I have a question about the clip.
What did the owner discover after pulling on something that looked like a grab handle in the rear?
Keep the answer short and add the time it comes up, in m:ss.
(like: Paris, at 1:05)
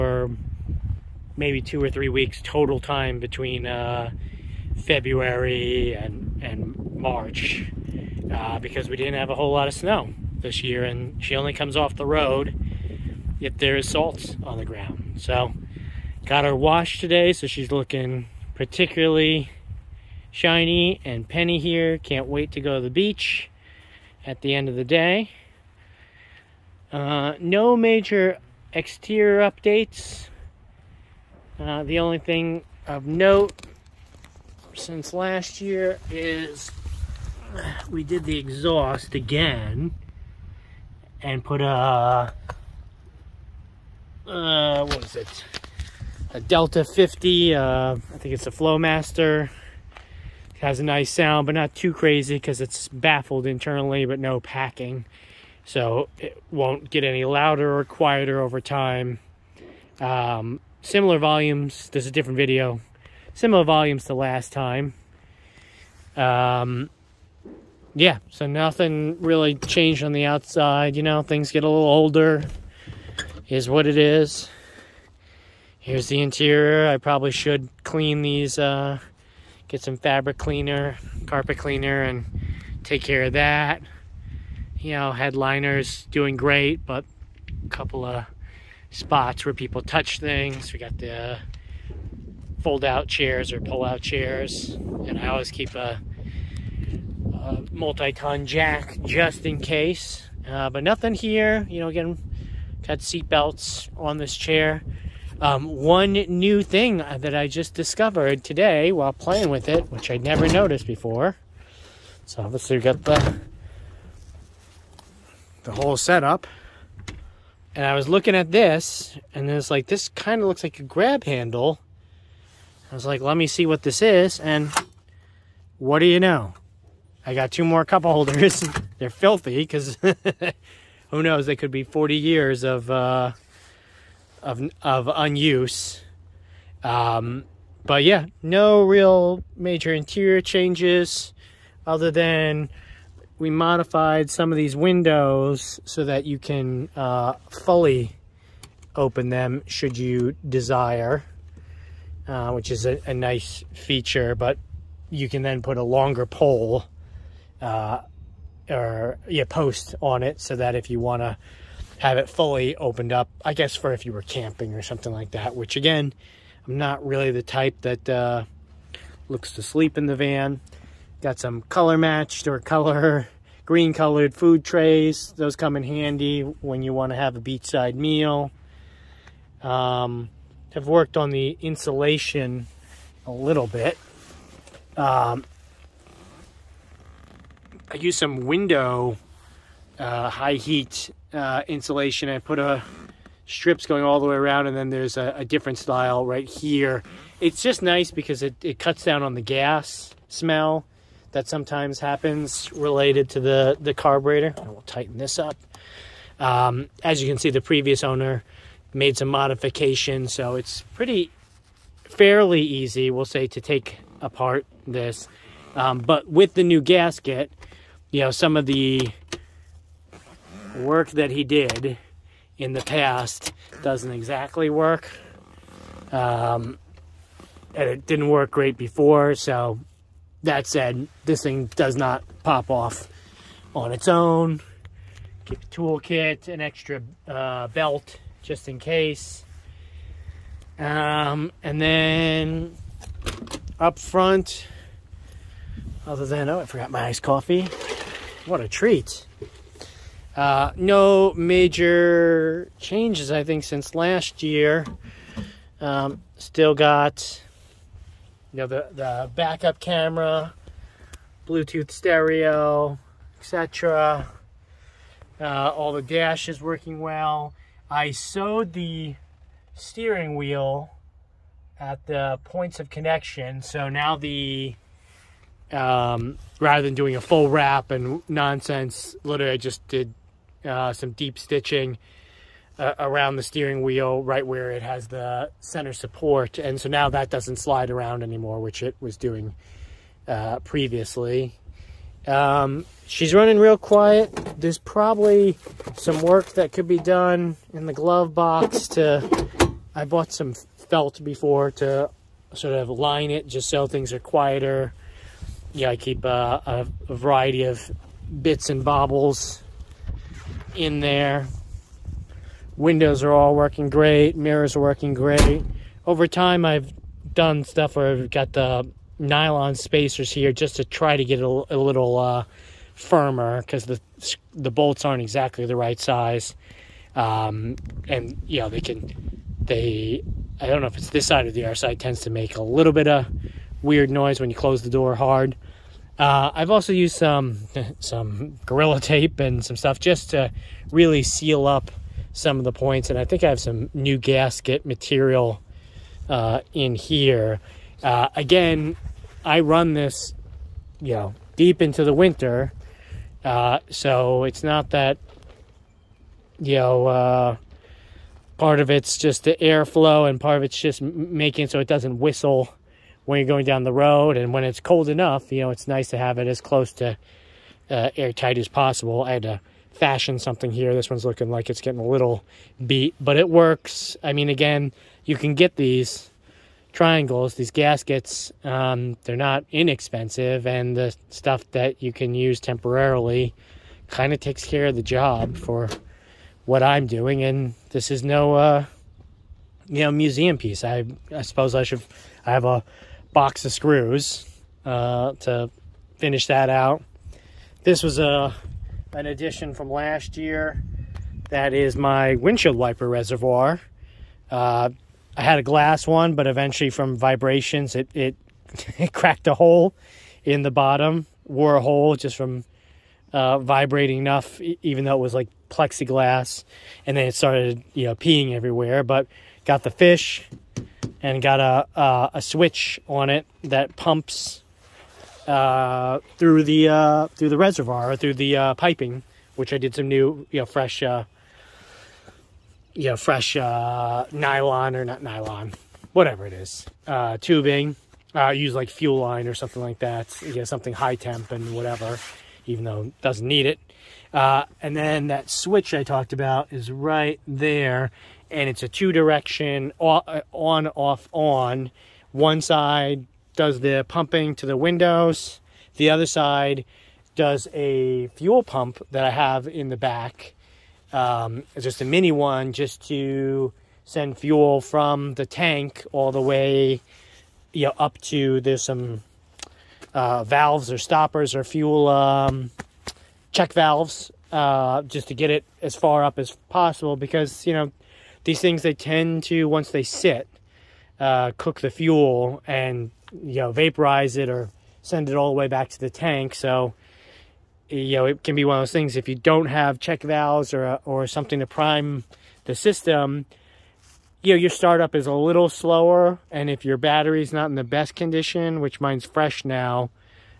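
two more cup holders, at 2:07.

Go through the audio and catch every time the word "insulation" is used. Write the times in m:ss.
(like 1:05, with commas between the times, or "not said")
3:01, 3:11.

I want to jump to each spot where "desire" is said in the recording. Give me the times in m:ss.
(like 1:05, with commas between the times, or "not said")
2:30.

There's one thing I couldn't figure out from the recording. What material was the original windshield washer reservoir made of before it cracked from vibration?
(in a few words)
glass.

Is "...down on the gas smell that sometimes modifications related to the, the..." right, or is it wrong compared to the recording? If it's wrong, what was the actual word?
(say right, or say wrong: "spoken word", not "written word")
wrong: "happens", not "modifications".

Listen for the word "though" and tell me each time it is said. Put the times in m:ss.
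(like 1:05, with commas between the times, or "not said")
6:55, 7:22.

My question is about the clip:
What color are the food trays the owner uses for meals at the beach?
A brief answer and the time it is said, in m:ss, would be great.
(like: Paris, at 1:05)
green, at 2:53.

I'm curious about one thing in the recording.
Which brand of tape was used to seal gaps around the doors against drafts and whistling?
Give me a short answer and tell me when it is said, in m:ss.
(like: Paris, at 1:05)
Gorilla Tape, at 5:38.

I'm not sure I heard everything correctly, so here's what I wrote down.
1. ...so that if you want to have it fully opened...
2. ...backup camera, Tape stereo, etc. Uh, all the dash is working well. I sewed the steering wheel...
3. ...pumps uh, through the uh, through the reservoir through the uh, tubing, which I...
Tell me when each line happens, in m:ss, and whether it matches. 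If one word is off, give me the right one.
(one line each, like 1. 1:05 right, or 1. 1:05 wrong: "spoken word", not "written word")
1. 2:40 right
2. 4:19 wrong: "Bluetooth", not "Tape"
3. 7:03 wrong: "piping", not "tubing".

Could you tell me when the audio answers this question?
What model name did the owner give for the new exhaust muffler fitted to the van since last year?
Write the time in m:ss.
0:46.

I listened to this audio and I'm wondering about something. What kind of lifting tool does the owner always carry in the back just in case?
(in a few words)
multi-ton jack.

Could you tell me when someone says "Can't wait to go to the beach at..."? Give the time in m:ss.
0:21.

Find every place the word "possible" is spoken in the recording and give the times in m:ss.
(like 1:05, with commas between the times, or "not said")
6:08, 7:56.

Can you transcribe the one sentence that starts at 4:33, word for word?
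So now the um, rather than doing a full wrap and nonsense.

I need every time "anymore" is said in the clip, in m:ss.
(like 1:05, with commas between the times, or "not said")
4:48.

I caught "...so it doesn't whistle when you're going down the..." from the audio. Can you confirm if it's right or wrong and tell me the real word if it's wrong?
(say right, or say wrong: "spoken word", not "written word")
right.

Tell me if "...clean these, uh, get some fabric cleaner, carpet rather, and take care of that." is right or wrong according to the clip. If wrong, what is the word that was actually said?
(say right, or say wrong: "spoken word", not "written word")
wrong: "cleaner", not "rather".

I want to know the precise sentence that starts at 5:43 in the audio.
And I think I have some new gasket material uh, in here.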